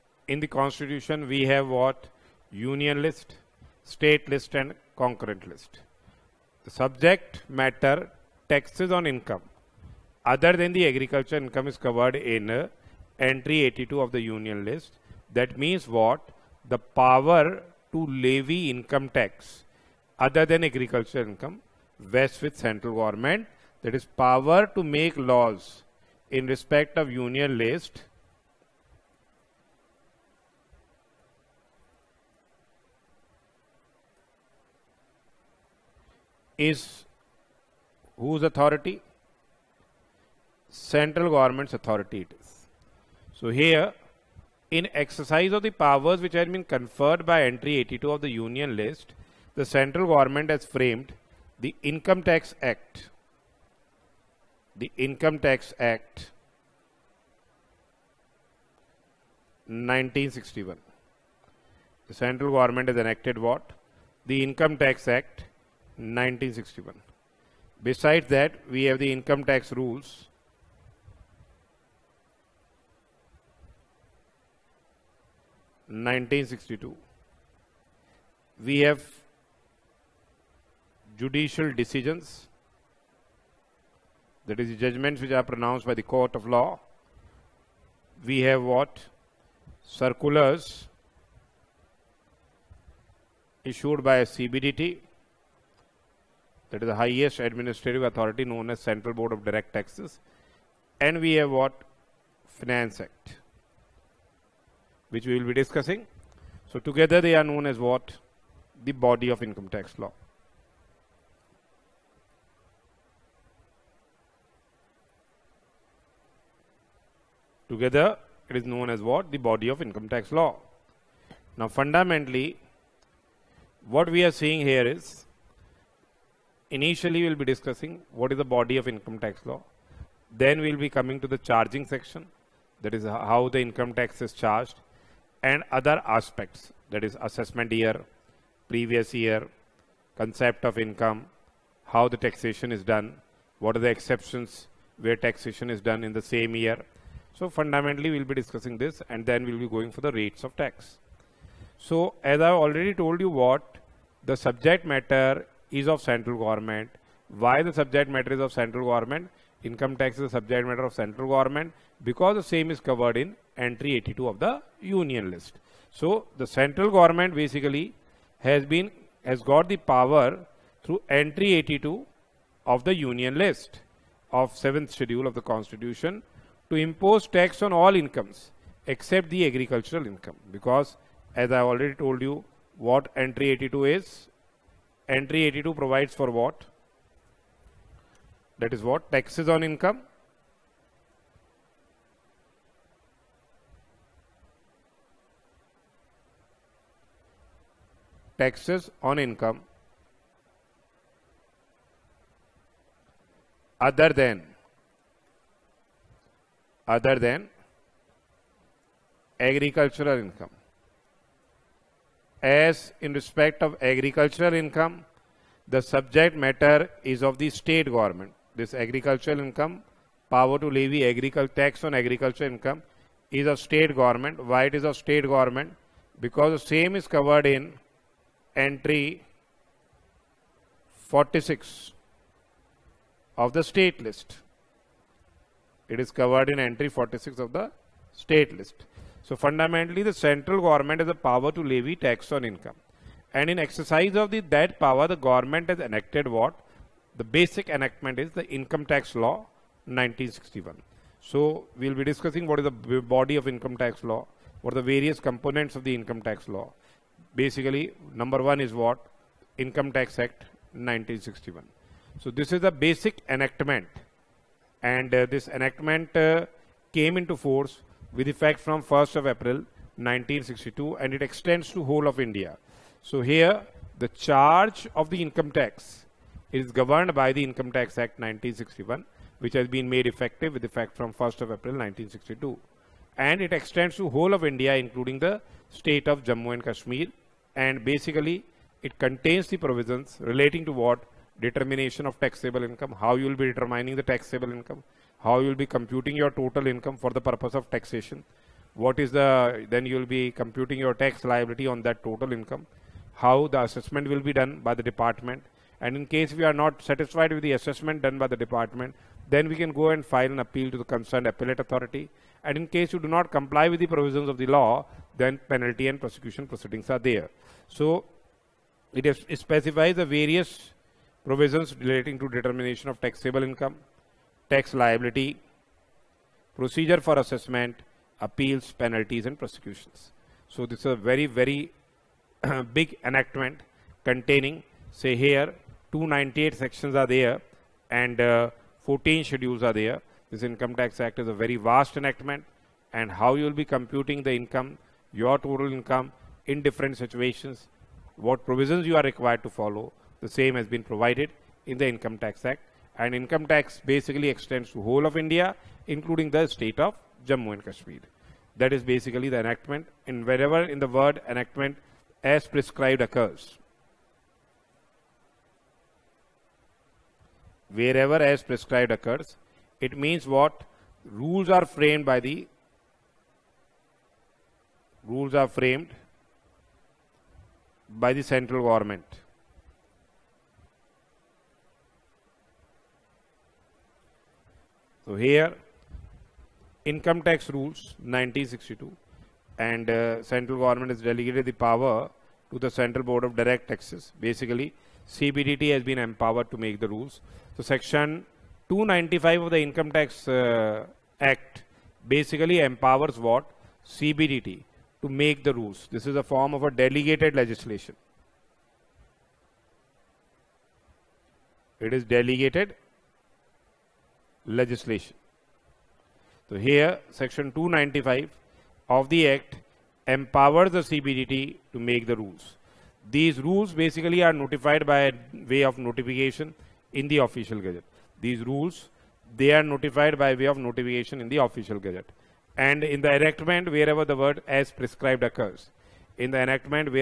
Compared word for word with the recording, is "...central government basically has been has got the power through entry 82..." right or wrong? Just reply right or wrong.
right.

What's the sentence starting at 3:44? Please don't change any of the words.
Why it is of state government?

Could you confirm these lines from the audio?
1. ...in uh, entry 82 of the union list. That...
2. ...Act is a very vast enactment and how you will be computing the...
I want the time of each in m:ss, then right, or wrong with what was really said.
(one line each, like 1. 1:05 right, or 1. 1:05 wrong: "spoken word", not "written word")
1. 0:12 right
2. 5:41 right.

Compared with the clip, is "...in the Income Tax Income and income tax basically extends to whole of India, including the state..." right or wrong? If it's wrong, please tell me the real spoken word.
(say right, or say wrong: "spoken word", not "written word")
wrong: "Act", not "Income".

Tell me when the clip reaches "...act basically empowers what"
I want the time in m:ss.
6:41.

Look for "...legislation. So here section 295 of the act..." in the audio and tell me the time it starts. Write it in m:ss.
6:54.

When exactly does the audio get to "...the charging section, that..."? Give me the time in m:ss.
2:11.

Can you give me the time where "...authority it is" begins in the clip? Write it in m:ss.
0:41.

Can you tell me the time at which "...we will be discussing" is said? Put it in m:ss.
1:45.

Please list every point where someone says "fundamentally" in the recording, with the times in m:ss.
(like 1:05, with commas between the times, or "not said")
2:01, 2:27, 3:59.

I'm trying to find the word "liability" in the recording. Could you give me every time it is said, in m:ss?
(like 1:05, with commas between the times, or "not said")
5:01, 5:24.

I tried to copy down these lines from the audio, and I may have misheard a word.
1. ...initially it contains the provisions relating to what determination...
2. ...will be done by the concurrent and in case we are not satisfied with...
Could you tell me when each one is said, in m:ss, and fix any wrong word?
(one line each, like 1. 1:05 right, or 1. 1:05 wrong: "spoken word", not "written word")
1. 4:47 wrong: "basically", not "initially"
2. 5:04 wrong: "department", not "concurrent".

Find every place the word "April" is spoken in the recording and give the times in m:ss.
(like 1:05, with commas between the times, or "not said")
4:29, 4:41.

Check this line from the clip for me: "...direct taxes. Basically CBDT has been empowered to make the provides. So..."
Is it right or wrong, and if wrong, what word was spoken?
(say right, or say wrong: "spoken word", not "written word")
wrong: "rules", not "provides".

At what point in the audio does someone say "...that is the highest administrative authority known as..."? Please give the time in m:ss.
1:36.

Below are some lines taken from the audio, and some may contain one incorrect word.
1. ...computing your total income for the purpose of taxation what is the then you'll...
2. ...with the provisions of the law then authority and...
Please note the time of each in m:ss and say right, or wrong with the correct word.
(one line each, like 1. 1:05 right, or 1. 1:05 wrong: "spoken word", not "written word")
1. 4:55 right
2. 5:13 wrong: "penalty", not "authority".